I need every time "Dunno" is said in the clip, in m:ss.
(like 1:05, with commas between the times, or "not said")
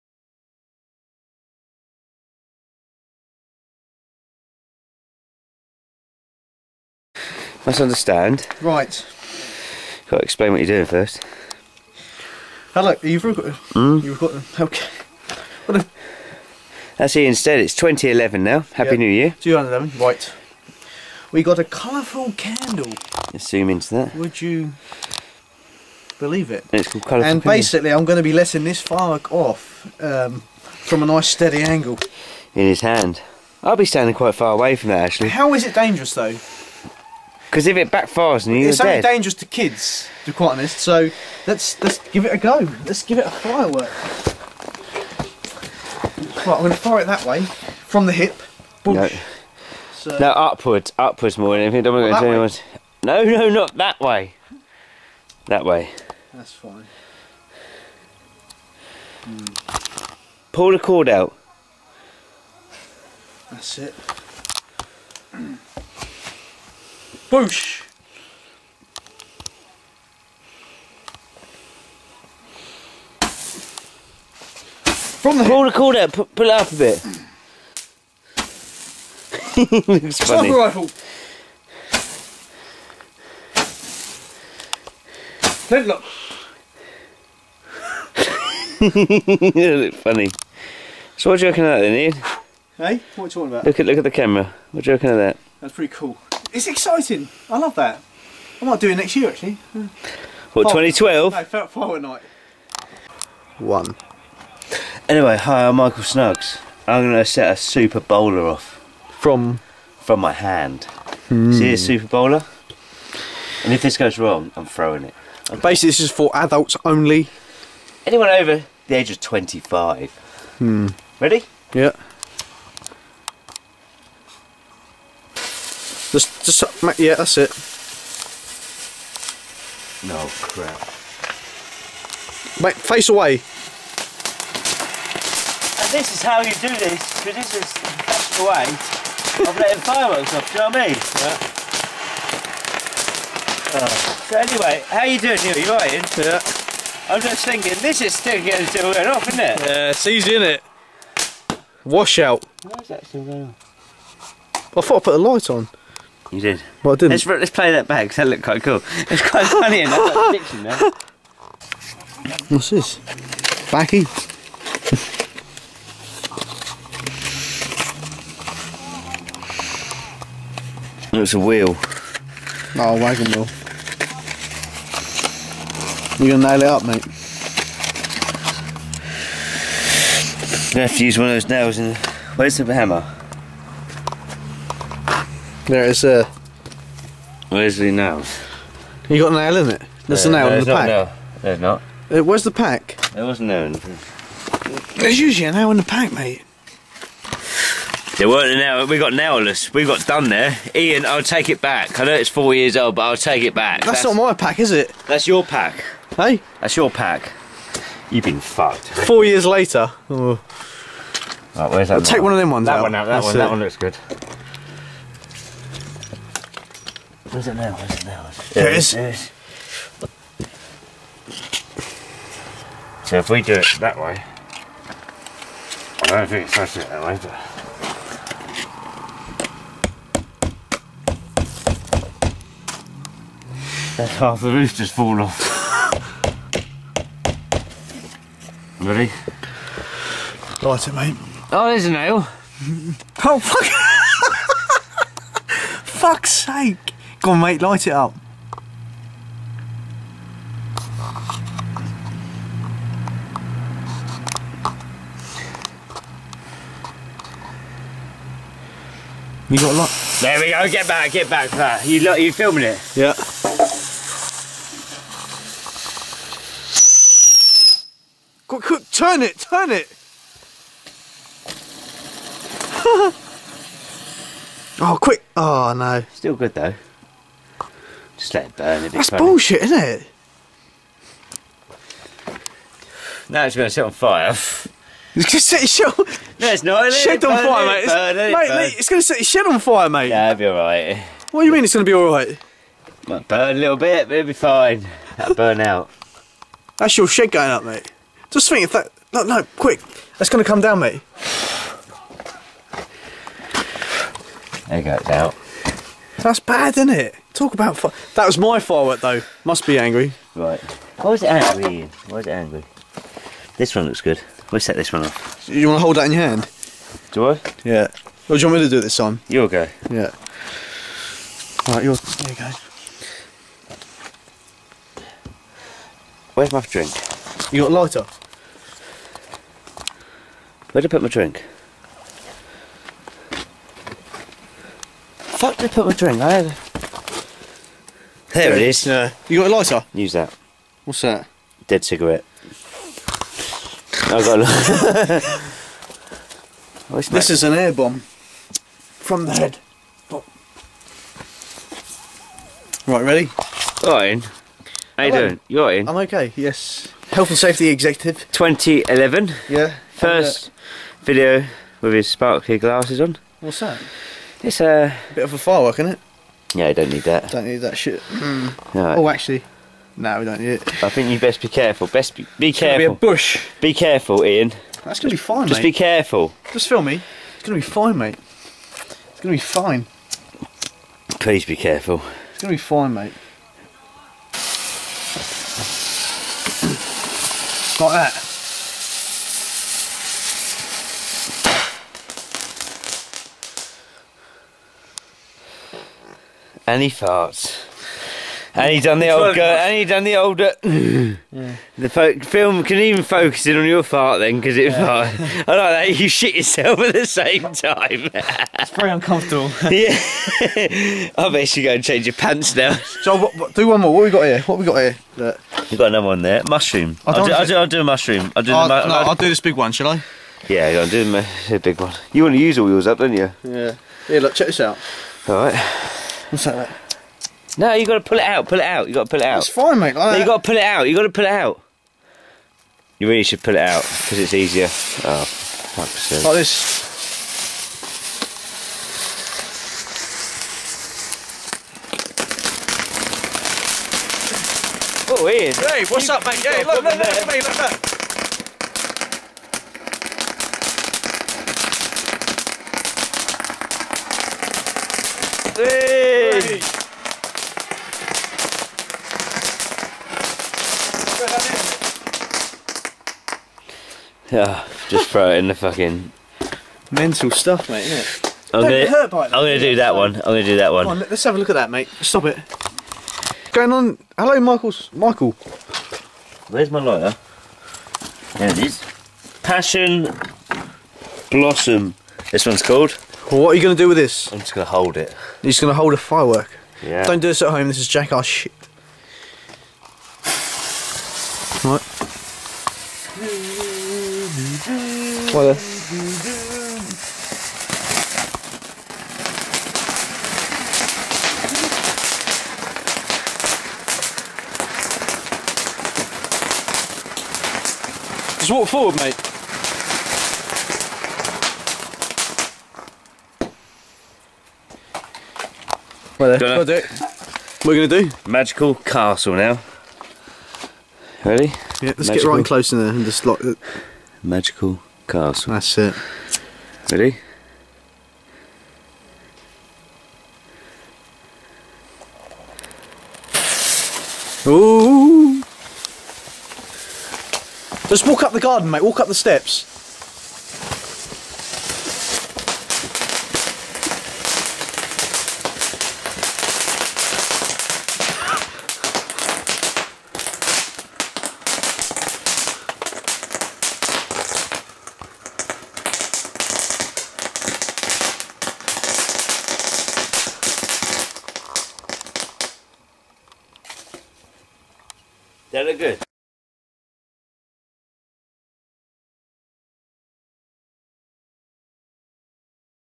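8:36.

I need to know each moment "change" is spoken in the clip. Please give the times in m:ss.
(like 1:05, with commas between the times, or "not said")
6:51.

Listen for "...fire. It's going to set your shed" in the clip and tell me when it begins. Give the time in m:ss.
4:43.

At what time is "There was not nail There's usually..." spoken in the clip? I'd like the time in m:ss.
3:13.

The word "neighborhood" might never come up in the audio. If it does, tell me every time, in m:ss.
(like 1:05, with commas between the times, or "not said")
not said.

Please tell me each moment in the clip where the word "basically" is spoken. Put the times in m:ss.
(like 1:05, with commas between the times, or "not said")
0:27, 1:55.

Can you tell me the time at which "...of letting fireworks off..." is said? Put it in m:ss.
2:19.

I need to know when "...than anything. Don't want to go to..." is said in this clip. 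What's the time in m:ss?
0:51.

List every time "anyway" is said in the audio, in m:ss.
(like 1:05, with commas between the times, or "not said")
1:45, 2:24.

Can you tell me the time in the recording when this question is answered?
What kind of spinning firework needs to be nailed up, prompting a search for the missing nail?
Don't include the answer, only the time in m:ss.
2:52.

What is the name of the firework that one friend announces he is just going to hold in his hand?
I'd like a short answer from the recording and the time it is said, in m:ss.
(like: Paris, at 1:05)
Passion blossom, at 7:59.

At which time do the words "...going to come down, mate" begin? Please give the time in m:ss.
5:00.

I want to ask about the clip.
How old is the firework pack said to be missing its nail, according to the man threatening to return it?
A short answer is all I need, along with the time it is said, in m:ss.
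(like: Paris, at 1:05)
4 years, at 3:22.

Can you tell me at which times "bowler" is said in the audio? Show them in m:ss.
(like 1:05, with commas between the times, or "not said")
1:47, 1:52.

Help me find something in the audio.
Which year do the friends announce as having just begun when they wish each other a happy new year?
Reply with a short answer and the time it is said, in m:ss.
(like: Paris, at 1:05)
2011, at 0:17.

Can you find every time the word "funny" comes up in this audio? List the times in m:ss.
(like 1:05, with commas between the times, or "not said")
1:20, 1:29, 2:39, 4:39.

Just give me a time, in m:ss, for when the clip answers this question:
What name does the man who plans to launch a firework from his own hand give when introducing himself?
1:45.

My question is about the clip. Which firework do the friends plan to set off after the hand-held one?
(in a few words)
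Magical castle.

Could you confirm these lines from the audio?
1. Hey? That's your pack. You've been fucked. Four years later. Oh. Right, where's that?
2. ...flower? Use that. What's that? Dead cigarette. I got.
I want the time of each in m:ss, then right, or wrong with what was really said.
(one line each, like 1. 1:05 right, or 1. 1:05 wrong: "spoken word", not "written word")
1. 3:26 right
2. 5:39 wrong: "lighter", not "flower".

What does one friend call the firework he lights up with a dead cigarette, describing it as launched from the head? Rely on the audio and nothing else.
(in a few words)
Air bomb.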